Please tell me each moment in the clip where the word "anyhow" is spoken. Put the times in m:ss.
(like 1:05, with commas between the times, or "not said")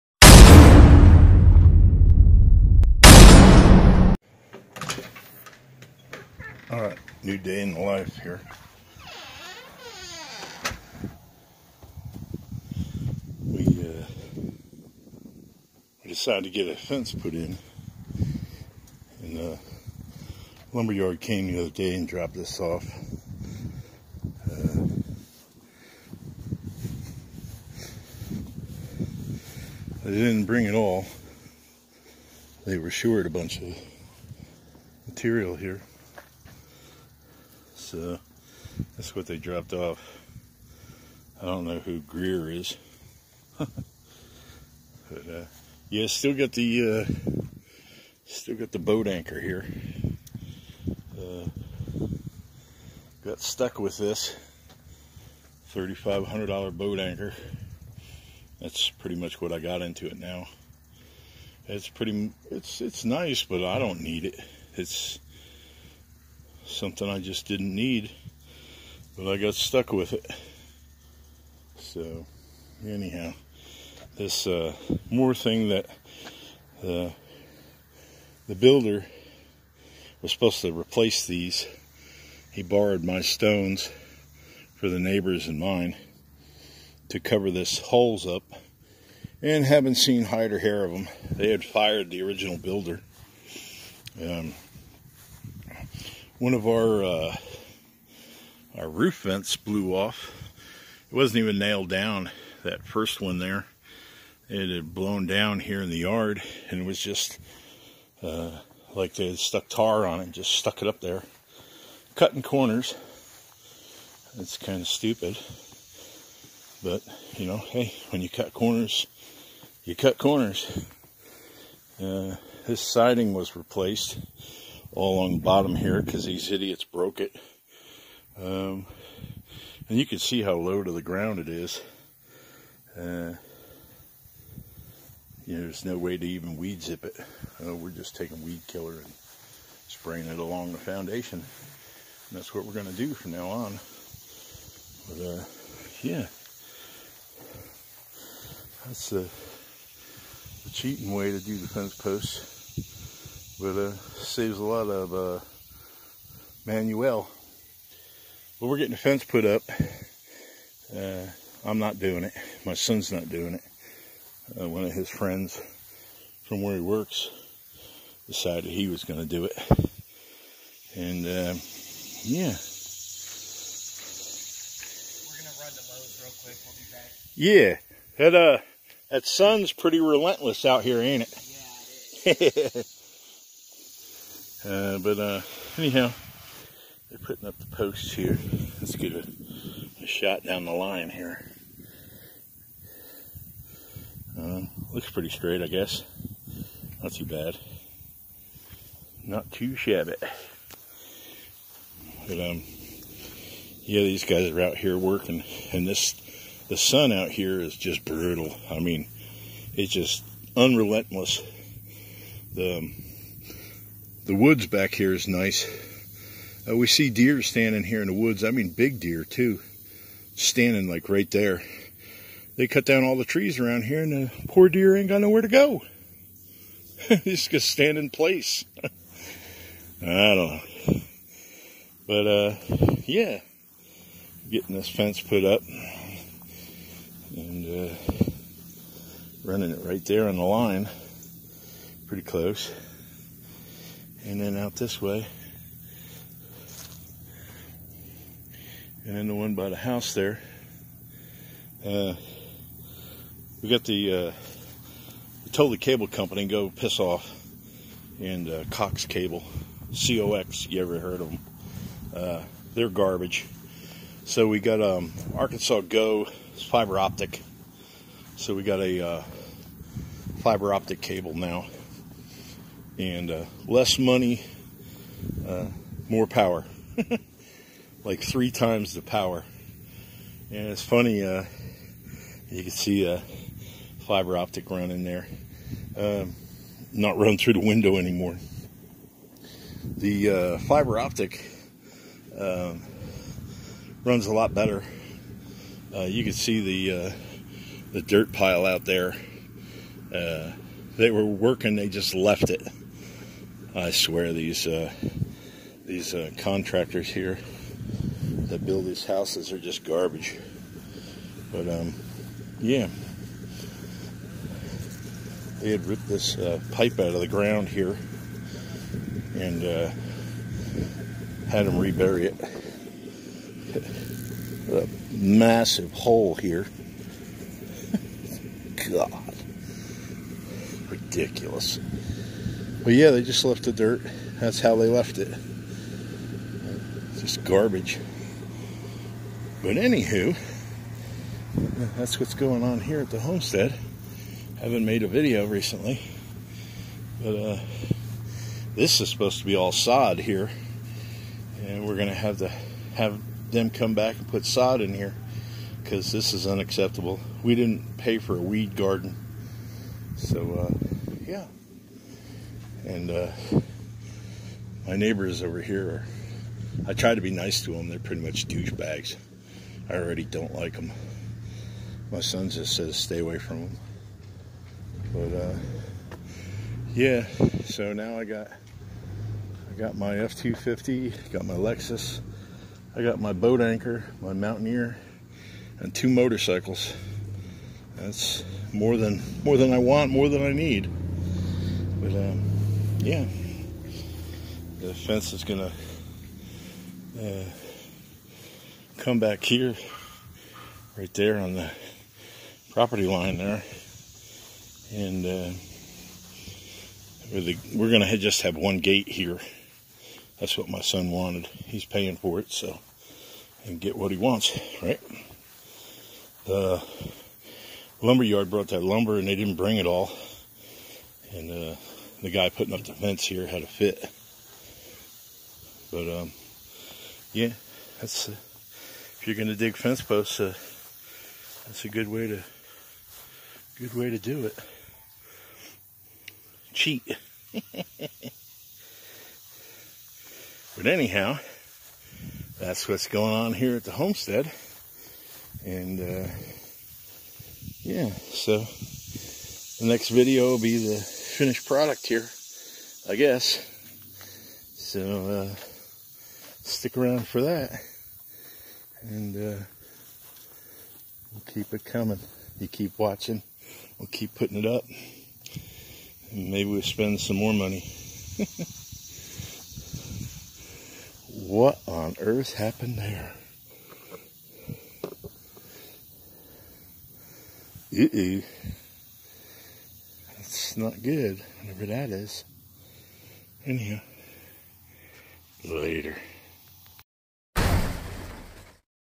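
1:12, 3:05, 7:20, 8:03.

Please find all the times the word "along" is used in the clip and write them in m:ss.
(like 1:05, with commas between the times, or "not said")
2:05, 2:20.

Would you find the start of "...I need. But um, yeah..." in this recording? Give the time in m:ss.
6:30.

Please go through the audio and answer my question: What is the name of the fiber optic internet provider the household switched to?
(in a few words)
Arkansas Go.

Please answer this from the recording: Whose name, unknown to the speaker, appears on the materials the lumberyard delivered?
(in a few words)
Greer.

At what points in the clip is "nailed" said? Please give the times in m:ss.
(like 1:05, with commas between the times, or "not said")
1:41.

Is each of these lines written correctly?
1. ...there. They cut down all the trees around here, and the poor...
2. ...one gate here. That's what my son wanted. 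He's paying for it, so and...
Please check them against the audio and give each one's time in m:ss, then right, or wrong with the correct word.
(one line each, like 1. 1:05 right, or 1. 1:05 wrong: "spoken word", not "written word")
1. 3:41 right
2. 6:48 right.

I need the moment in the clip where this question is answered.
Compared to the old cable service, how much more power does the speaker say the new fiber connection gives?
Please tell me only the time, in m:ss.
4:38.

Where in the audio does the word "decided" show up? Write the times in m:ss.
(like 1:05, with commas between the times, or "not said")
0:16, 2:48.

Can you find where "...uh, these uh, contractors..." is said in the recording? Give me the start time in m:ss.
5:04.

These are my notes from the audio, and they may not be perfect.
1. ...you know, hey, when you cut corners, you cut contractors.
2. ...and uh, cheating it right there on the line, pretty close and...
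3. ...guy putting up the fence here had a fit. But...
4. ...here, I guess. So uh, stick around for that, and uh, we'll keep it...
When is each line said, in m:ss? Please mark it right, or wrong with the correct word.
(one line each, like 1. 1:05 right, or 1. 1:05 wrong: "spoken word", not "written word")
1. 1:57 wrong: "corners", not "contractors"
2. 3:57 wrong: "running", not "cheating"
3. 7:02 right
4. 7:32 right.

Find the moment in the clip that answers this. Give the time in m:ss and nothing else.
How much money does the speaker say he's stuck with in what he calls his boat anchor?
0:55.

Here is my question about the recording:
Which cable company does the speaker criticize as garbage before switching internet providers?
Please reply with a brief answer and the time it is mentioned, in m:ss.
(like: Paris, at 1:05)
Cox Cable, at 4:18.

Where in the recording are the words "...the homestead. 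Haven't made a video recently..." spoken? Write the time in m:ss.
5:43.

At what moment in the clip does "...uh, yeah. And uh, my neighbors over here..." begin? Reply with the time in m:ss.
6:00.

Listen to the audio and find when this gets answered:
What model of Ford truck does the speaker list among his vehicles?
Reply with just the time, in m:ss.
6:20.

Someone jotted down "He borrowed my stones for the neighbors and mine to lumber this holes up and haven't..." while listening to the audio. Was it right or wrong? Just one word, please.
wrong.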